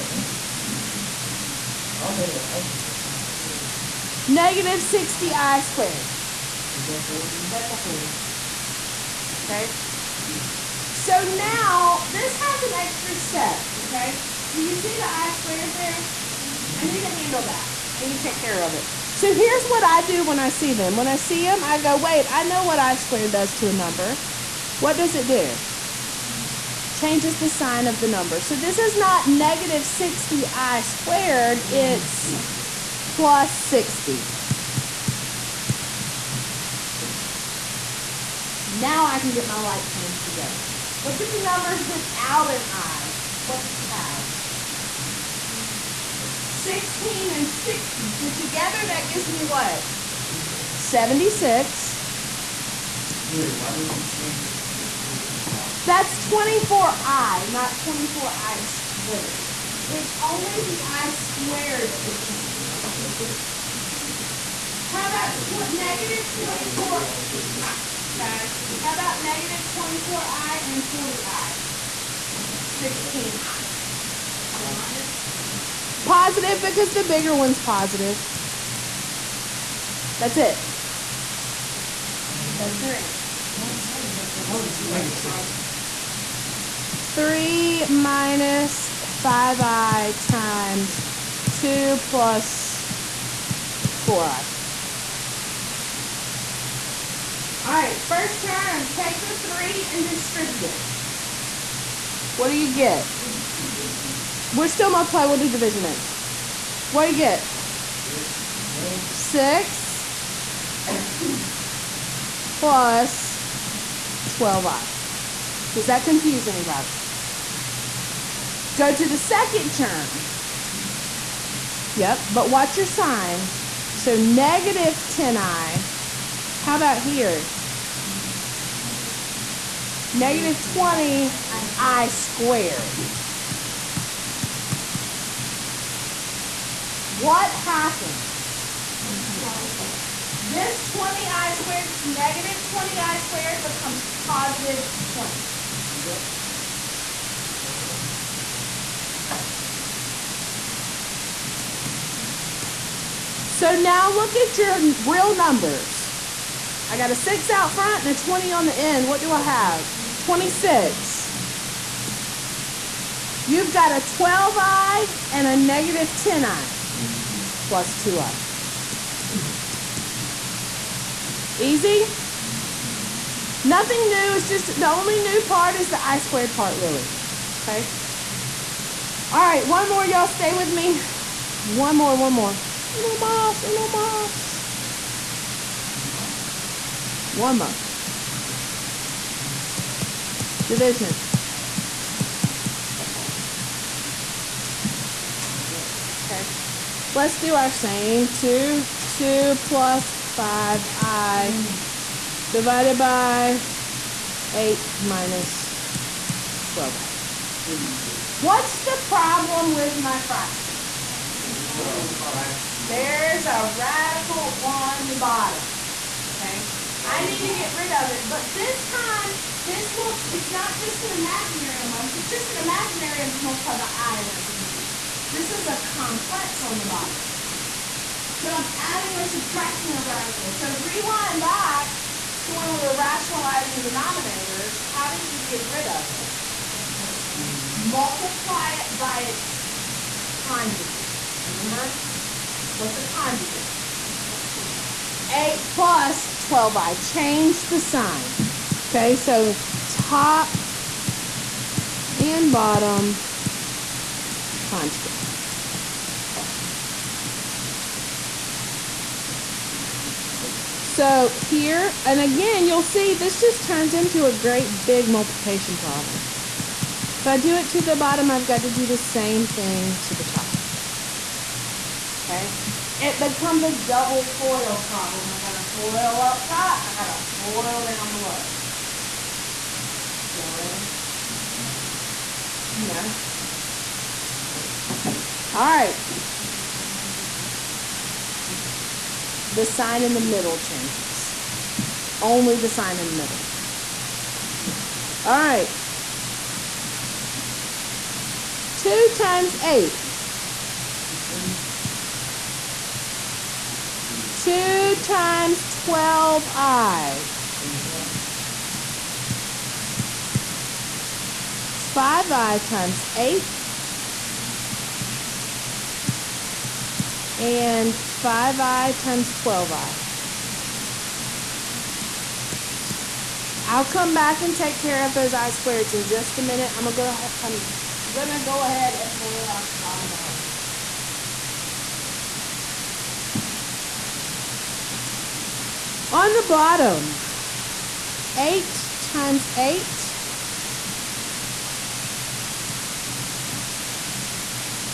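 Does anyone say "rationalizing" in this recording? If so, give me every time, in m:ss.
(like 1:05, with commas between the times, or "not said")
3:52.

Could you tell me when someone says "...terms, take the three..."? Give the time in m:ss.
1:38.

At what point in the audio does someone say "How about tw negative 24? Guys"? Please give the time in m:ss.
1:04.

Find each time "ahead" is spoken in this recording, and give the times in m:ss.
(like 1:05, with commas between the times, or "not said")
5:28.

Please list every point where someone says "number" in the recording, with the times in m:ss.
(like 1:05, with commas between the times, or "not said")
0:23, 0:28, 0:41, 2:35.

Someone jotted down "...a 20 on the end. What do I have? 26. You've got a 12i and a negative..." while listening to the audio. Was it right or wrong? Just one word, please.
right.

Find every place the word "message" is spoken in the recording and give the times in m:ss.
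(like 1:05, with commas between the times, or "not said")
not said.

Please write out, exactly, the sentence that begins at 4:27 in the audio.
If I do it to the bottom, I've got to do the same thing to the top.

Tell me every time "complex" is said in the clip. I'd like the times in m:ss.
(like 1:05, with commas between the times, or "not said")
3:45.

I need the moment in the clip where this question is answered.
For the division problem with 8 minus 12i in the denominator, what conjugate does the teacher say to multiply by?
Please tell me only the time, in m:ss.
4:05.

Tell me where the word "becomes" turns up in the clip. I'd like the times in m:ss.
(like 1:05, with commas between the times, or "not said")
2:23, 4:33.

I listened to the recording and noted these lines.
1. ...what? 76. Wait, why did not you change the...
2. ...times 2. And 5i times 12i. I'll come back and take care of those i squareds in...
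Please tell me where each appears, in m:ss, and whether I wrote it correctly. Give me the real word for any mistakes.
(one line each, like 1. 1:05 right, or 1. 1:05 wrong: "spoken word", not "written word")
1. 0:49 right
2. 5:12 wrong: "8", not "2".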